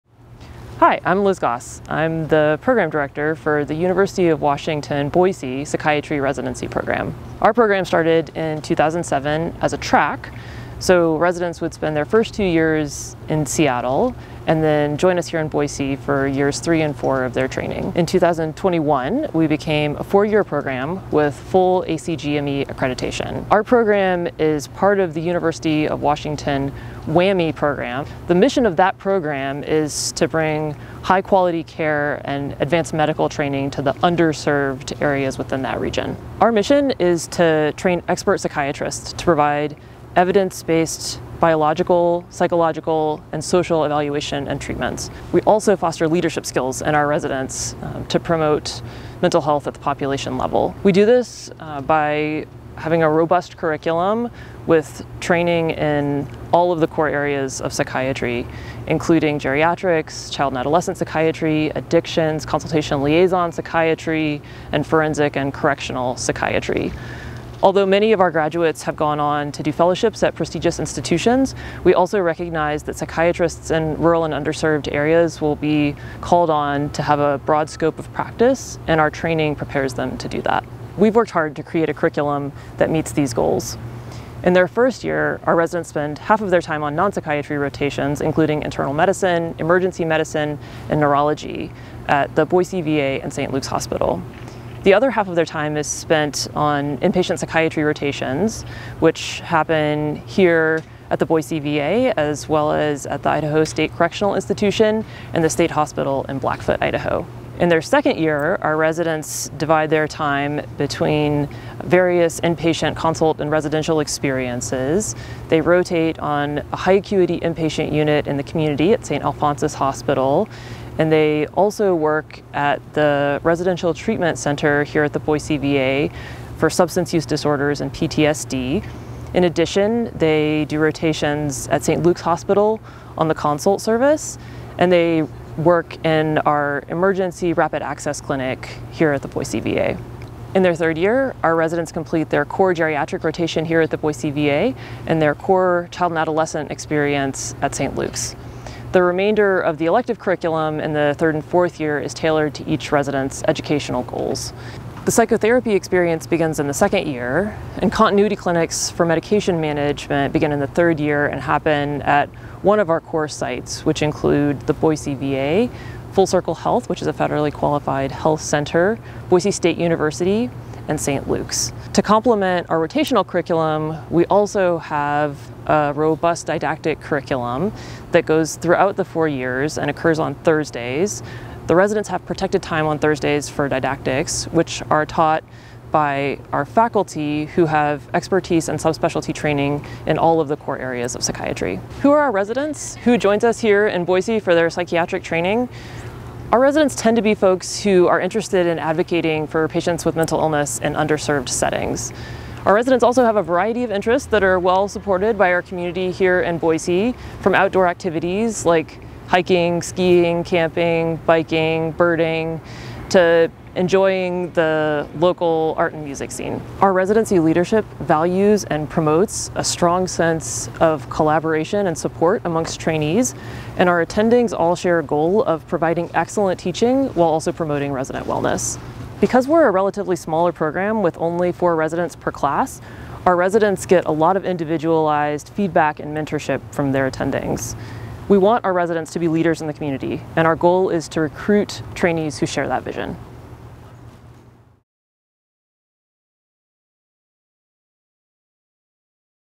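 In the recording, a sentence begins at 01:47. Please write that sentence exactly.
In their second year, our residents divide their time between various inpatient consult and residential experiences.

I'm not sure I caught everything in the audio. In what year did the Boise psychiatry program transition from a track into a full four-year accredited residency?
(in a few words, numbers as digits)
2021.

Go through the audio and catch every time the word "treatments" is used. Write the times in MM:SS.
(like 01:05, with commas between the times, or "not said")
00:44, 02:03.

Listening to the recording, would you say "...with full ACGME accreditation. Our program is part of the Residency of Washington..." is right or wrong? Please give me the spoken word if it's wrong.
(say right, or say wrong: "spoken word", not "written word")
wrong: "University", not "Residency".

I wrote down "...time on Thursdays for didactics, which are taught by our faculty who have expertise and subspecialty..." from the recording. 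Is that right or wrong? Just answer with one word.
right.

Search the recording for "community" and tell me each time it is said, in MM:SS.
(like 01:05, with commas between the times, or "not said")
01:58, 03:25, 03:59.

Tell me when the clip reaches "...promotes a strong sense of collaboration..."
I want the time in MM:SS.
03:38.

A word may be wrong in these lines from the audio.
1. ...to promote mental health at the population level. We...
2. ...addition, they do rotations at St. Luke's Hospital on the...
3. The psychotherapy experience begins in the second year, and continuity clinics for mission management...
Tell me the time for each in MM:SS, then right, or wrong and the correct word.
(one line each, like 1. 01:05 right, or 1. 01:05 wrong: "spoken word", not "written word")
1. 00:48 right
2. 02:09 right
3. 02:35 wrong: "medication", not "mission".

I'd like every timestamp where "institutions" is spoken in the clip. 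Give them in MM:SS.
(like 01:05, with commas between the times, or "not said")
01:10, 01:44.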